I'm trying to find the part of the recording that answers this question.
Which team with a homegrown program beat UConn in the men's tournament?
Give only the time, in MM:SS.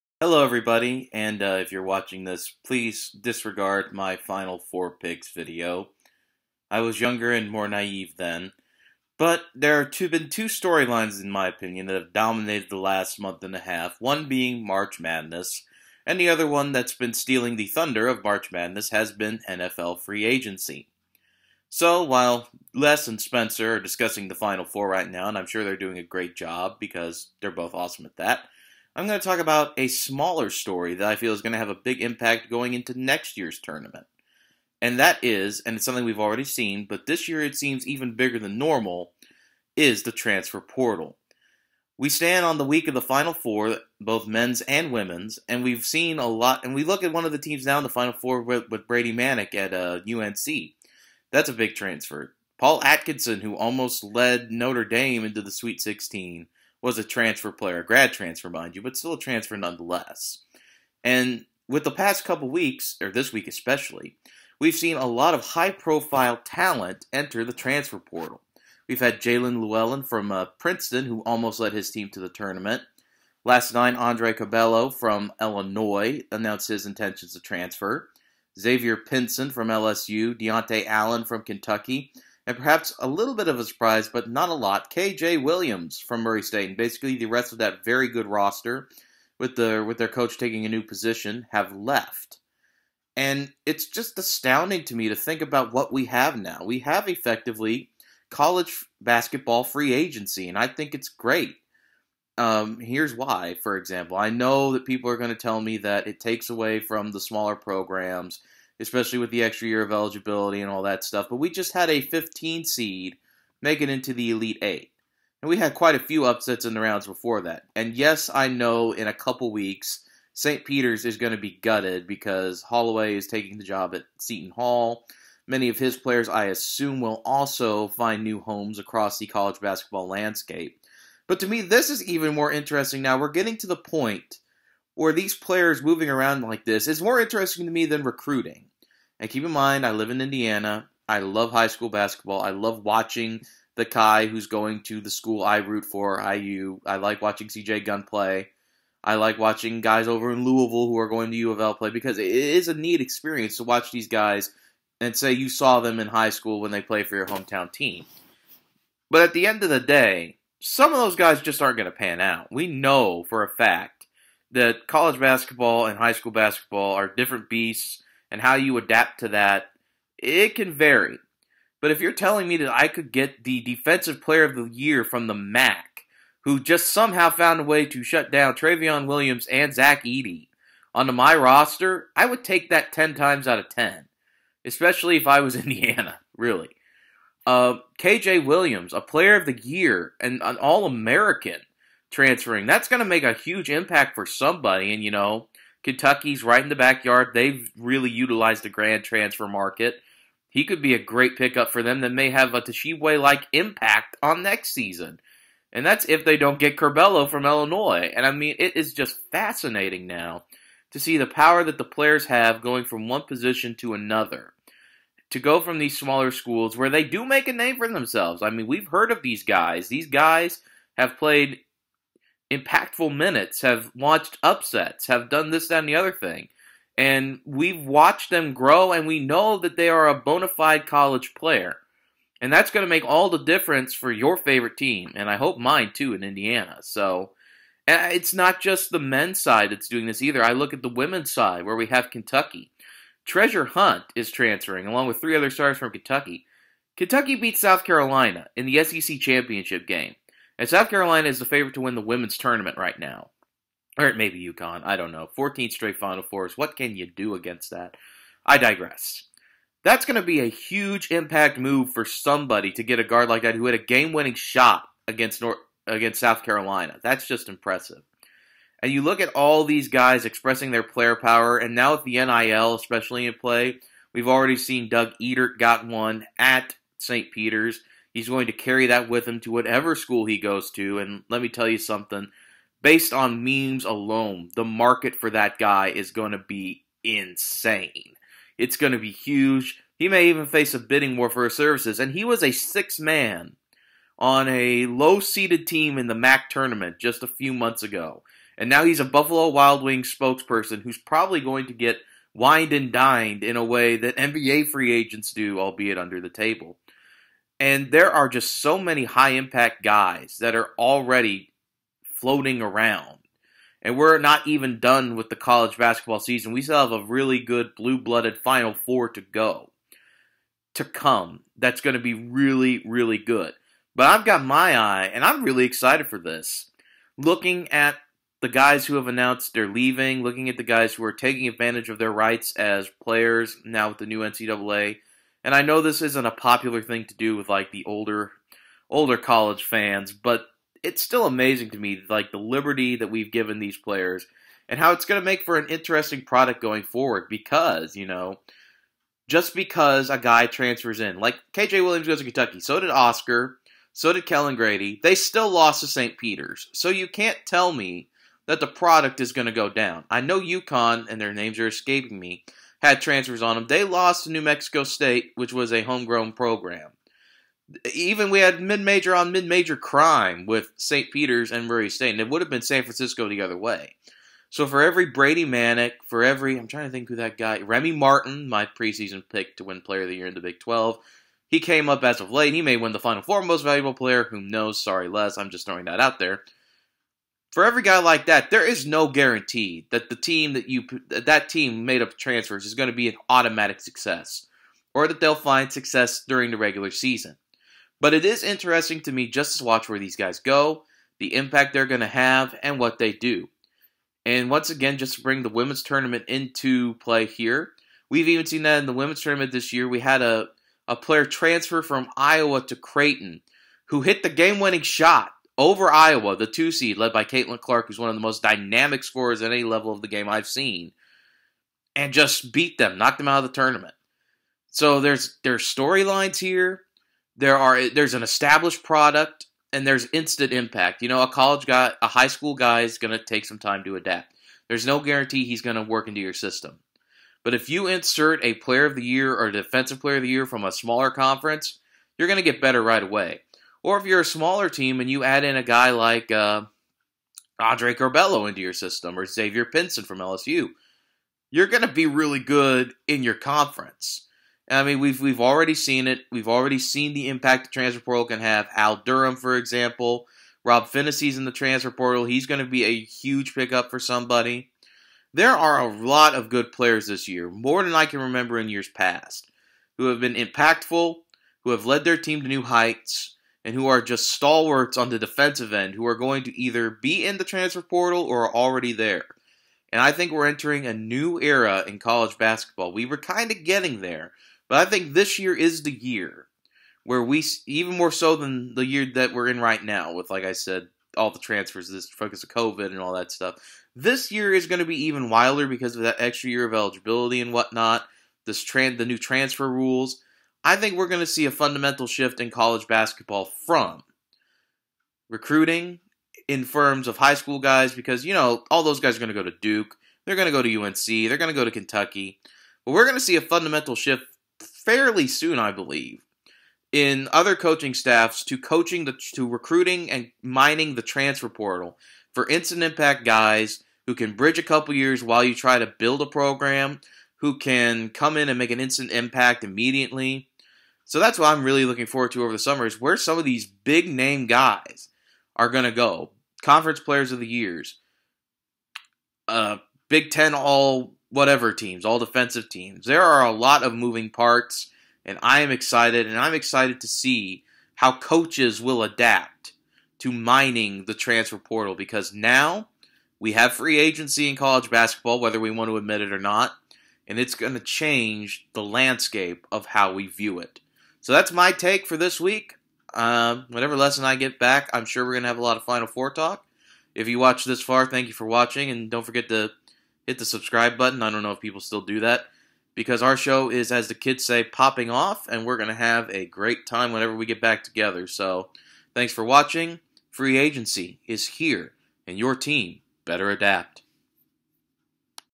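06:04.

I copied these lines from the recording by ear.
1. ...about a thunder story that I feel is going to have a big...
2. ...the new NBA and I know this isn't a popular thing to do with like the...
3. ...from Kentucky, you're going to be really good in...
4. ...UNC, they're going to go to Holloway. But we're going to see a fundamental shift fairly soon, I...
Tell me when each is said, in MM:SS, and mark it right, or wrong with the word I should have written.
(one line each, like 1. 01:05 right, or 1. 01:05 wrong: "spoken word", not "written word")
1. 00:29 wrong: "smaller", not "thunder"
2. 05:33 wrong: "NCAA", not "NBA"
3. 07:30 wrong: "LSU", not "Kentucky"
4. 08:30 wrong: "Kentucky", not "Holloway".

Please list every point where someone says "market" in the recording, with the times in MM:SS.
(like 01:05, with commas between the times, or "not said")
03:19, 04:44.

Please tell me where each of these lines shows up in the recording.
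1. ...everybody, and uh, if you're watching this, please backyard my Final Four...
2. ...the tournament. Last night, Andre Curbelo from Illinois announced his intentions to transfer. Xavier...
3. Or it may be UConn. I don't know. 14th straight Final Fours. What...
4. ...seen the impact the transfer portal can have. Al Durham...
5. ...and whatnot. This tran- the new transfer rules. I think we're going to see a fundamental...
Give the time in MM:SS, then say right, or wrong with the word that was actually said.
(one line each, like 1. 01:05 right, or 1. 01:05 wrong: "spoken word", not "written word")
1. 00:00 wrong: "disregard", not "backyard"
2. 01:12 right
3. 04:13 right
4. 07:36 right
5. 08:17 right.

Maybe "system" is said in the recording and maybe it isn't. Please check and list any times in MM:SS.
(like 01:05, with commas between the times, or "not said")
07:16, 07:28.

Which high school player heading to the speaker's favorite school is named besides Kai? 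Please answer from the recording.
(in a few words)
CJ Gunn.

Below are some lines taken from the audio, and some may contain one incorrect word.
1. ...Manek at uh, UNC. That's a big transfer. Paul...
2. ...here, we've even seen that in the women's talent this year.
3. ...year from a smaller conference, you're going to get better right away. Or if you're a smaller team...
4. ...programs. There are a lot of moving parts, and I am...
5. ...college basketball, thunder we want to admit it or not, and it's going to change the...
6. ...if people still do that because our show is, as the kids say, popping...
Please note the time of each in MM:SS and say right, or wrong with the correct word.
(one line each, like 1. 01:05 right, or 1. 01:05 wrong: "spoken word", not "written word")
1. 00:49 right
2. 06:47 wrong: "tournament", not "talent"
3. 07:20 right
4. 09:02 wrong: "teams", not "programs"
5. 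09:14 wrong: "whether", not "thunder"
6. 09:31 right.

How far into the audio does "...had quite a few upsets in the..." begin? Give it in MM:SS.
01:55.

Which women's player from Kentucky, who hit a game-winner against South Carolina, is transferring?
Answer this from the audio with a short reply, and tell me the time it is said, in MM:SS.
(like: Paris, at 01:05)
Treasure Hunt, at 04:03.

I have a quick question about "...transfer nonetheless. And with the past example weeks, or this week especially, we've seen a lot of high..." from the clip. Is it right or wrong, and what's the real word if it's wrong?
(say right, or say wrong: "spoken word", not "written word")
wrong: "couple", not "example".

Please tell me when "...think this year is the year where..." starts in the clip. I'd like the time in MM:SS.
08:04.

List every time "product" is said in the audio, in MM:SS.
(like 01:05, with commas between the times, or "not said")
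05:46, 05:58, 07:08.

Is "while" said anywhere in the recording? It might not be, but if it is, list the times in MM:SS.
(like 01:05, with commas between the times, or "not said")
00:22, 08:45.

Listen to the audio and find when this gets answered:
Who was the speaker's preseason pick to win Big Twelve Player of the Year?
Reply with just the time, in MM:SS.
06:17.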